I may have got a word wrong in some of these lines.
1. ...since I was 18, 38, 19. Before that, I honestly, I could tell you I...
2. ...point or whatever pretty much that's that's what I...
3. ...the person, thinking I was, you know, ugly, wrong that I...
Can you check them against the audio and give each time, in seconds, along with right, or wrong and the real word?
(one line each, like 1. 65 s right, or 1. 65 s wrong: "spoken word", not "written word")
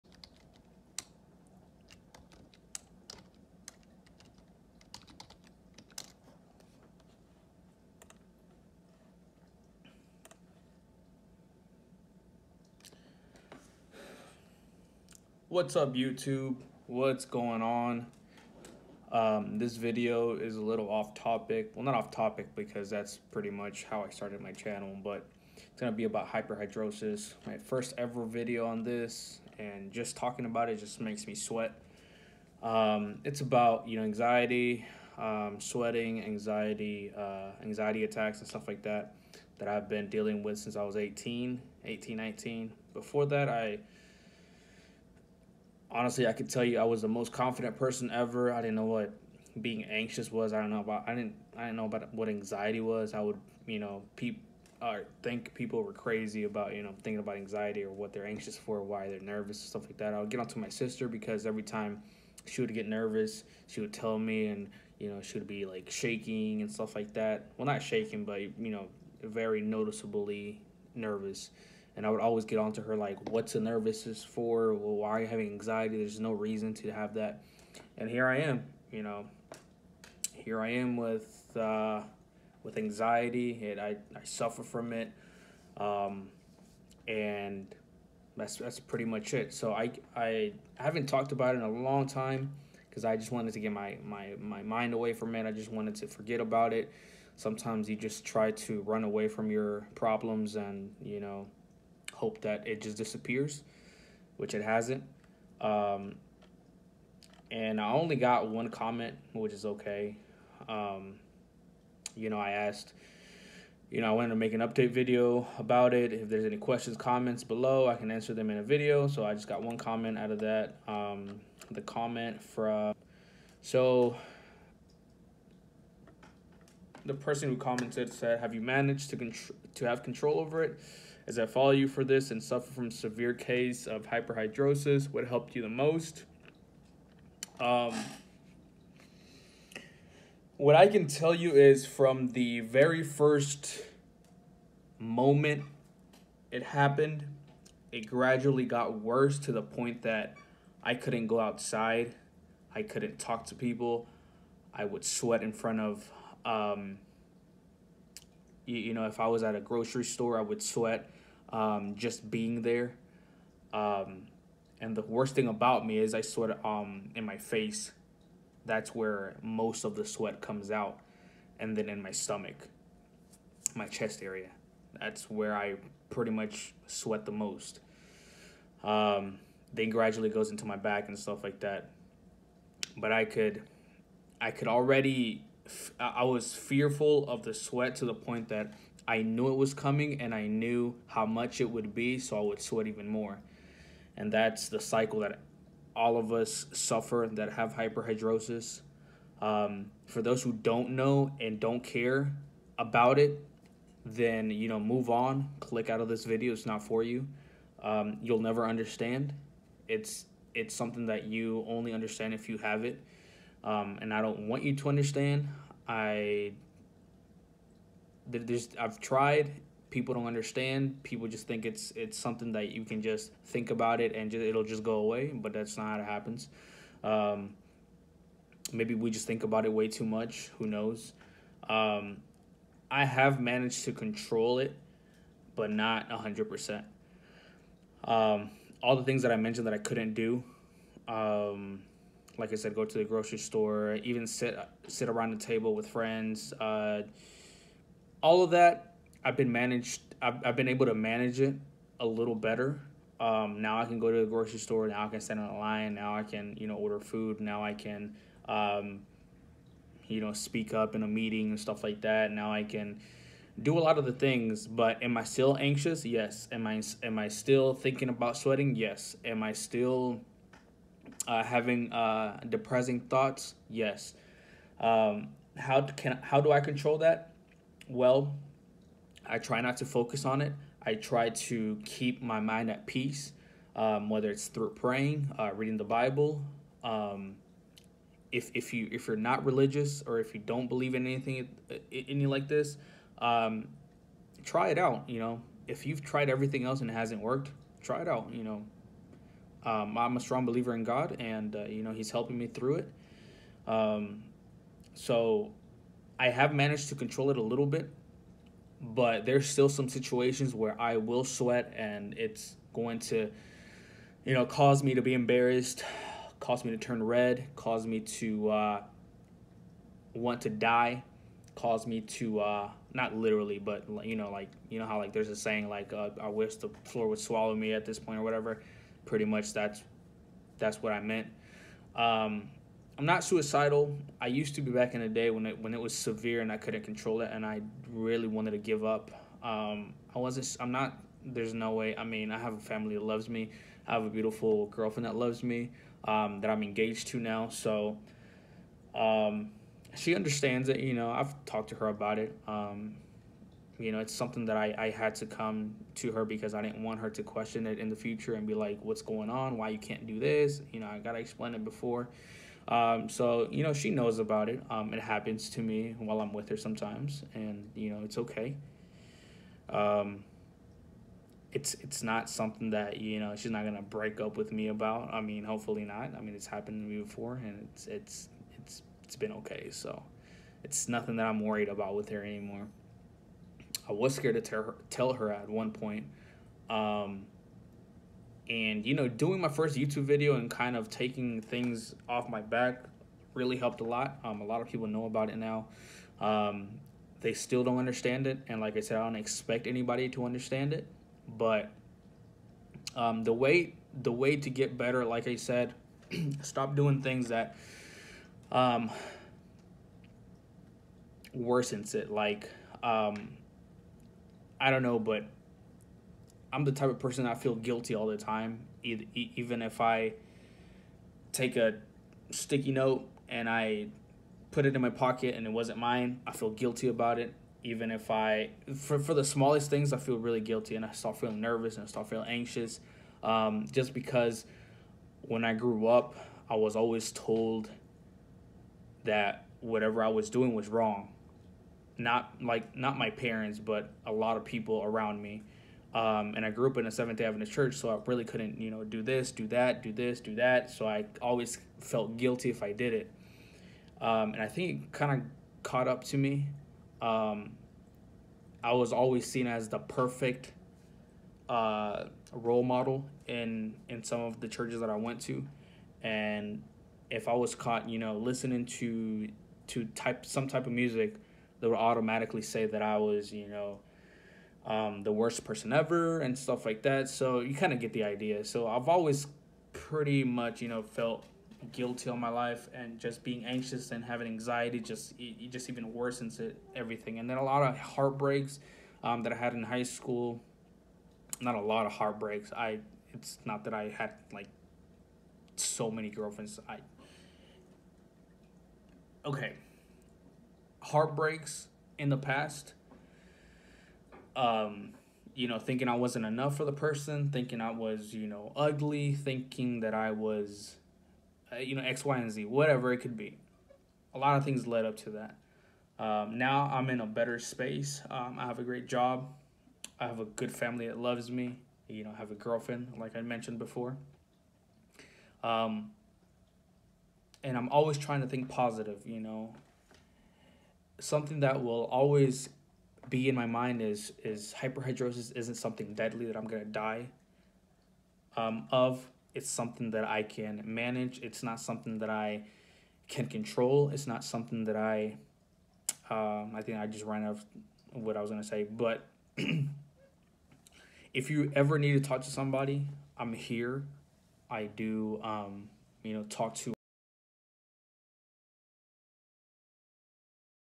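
1. 40 s wrong: "18", not "38"
2. 327 s right
3. 506 s wrong: "thinking", not "wrong".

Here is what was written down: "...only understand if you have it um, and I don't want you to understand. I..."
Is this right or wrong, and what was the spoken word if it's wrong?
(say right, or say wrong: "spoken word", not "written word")
right.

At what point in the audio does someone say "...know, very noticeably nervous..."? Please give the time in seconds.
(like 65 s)
68 s.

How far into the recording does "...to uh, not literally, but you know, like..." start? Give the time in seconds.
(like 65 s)
322 s.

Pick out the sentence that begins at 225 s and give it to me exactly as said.
But that's not how it happens.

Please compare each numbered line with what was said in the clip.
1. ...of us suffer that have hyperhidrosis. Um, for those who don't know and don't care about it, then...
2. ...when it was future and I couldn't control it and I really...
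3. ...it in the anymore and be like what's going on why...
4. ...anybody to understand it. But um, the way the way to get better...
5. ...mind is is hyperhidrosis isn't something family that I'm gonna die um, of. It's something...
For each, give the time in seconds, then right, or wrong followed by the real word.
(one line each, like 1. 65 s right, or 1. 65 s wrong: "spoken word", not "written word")
1. 196 s right
2. 335 s wrong: "severe", not "future"
3. 357 s wrong: "future", not "anymore"
4. 399 s right
5. 533 s wrong: "deadly", not "family".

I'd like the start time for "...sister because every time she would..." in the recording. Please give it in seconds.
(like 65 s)
60 s.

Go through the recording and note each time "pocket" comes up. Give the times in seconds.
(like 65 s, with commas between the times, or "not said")
424 s.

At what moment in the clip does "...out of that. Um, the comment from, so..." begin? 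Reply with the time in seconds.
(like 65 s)
120 s.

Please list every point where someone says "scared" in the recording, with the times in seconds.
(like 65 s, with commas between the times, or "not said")
384 s.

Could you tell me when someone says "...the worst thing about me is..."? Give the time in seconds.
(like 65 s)
164 s.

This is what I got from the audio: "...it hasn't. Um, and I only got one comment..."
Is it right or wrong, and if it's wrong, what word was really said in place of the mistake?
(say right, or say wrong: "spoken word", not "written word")
right.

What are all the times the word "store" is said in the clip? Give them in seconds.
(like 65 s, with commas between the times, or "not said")
160 s, 243 s, 254 s.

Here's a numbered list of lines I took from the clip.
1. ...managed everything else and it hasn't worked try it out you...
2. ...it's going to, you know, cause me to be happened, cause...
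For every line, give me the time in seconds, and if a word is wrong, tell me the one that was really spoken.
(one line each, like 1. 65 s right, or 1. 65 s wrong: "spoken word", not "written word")
1. 296 s wrong: "tried", not "managed"
2. 312 s wrong: "embarrassed", not "happened".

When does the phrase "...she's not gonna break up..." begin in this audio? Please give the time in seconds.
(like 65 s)
373 s.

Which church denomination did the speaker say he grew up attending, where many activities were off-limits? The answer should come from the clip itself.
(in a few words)
Seventh Day Adventist.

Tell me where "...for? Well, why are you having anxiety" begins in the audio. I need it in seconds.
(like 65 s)
74 s.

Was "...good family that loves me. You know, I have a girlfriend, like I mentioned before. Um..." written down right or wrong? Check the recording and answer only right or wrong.
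right.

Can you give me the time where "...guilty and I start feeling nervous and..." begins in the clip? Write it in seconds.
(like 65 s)
430 s.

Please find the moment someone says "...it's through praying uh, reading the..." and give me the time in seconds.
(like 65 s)
284 s.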